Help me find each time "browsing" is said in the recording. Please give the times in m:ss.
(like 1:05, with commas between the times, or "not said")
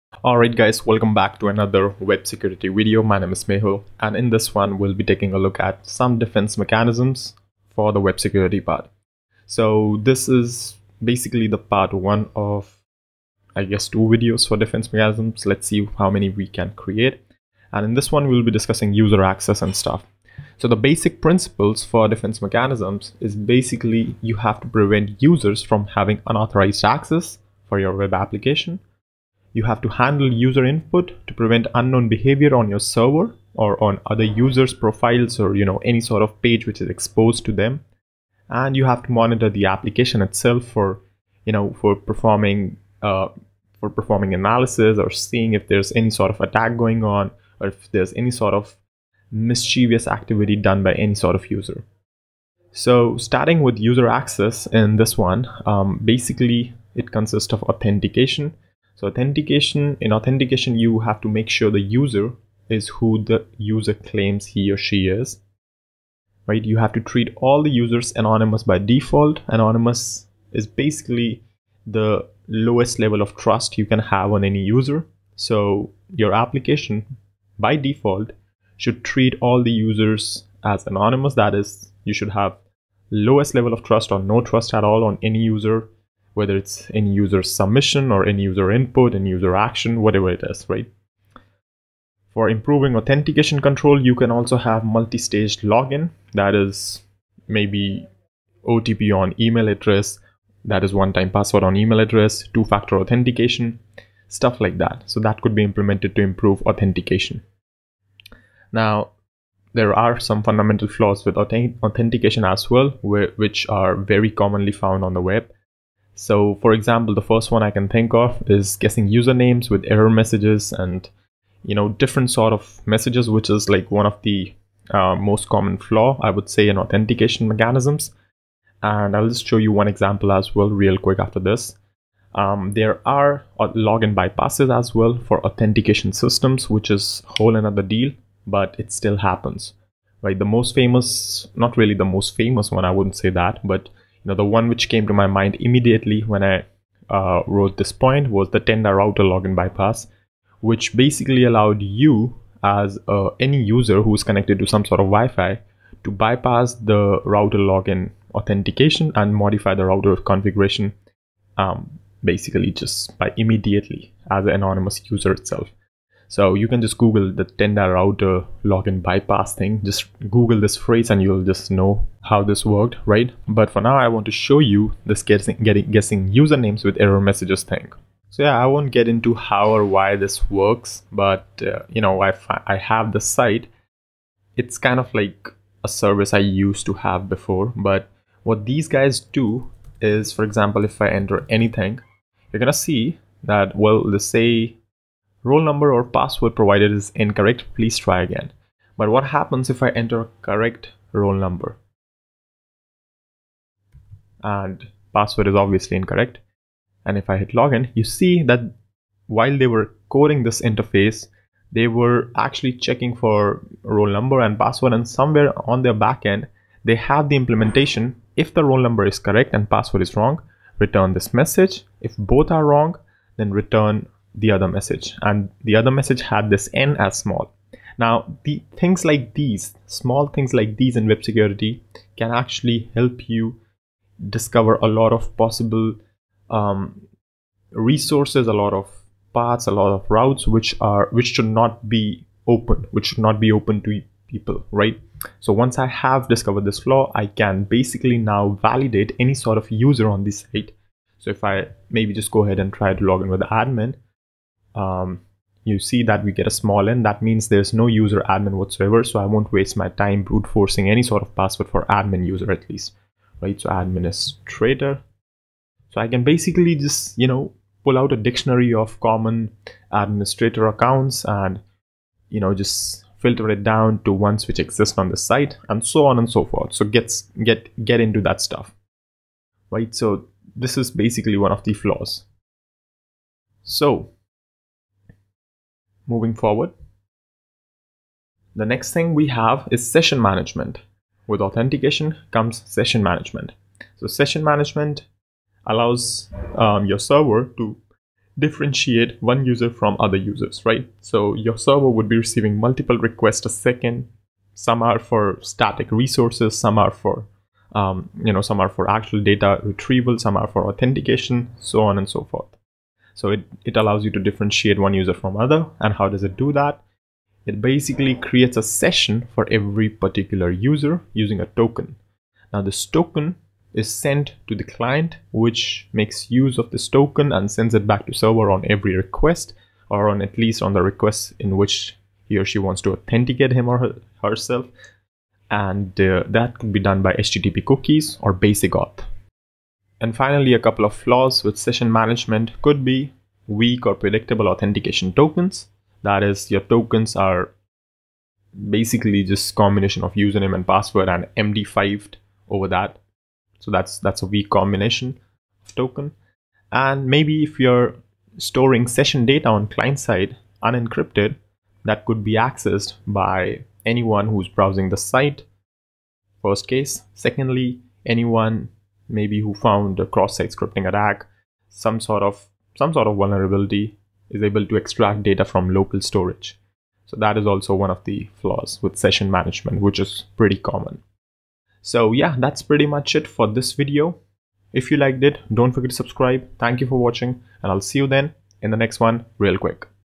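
6:04.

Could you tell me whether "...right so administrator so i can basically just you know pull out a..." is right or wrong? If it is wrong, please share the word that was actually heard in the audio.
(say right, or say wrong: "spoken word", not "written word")
right.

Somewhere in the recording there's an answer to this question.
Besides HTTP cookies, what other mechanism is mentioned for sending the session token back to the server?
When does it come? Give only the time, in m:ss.
5:38.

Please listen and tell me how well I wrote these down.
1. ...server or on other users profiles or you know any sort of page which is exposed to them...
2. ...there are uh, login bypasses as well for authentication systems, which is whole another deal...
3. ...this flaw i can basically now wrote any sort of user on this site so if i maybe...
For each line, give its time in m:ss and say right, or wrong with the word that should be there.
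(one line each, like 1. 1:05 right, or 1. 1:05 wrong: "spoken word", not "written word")
1. 0:32 right
2. 2:12 right
3. 4:06 wrong: "validate", not "wrote".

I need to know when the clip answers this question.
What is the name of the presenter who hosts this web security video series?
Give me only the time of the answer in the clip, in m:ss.
0:03.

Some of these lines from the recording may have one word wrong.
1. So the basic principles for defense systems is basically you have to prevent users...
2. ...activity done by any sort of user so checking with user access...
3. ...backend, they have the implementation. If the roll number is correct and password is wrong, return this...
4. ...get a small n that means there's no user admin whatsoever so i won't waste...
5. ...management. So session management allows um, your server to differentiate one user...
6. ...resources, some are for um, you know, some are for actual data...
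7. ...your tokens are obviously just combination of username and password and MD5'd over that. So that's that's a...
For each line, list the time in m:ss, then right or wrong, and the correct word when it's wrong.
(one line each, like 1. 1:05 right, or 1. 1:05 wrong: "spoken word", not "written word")
1. 0:20 wrong: "mechanisms", not "systems"
2. 0:50 wrong: "starting", not "checking"
3. 3:35 right
4. 4:16 right
5. 4:53 right
6. 5:05 right
7. 5:46 wrong: "basically", not "obviously".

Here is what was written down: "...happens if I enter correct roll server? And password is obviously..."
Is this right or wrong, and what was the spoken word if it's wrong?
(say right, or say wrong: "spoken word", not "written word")
wrong: "number", not "server".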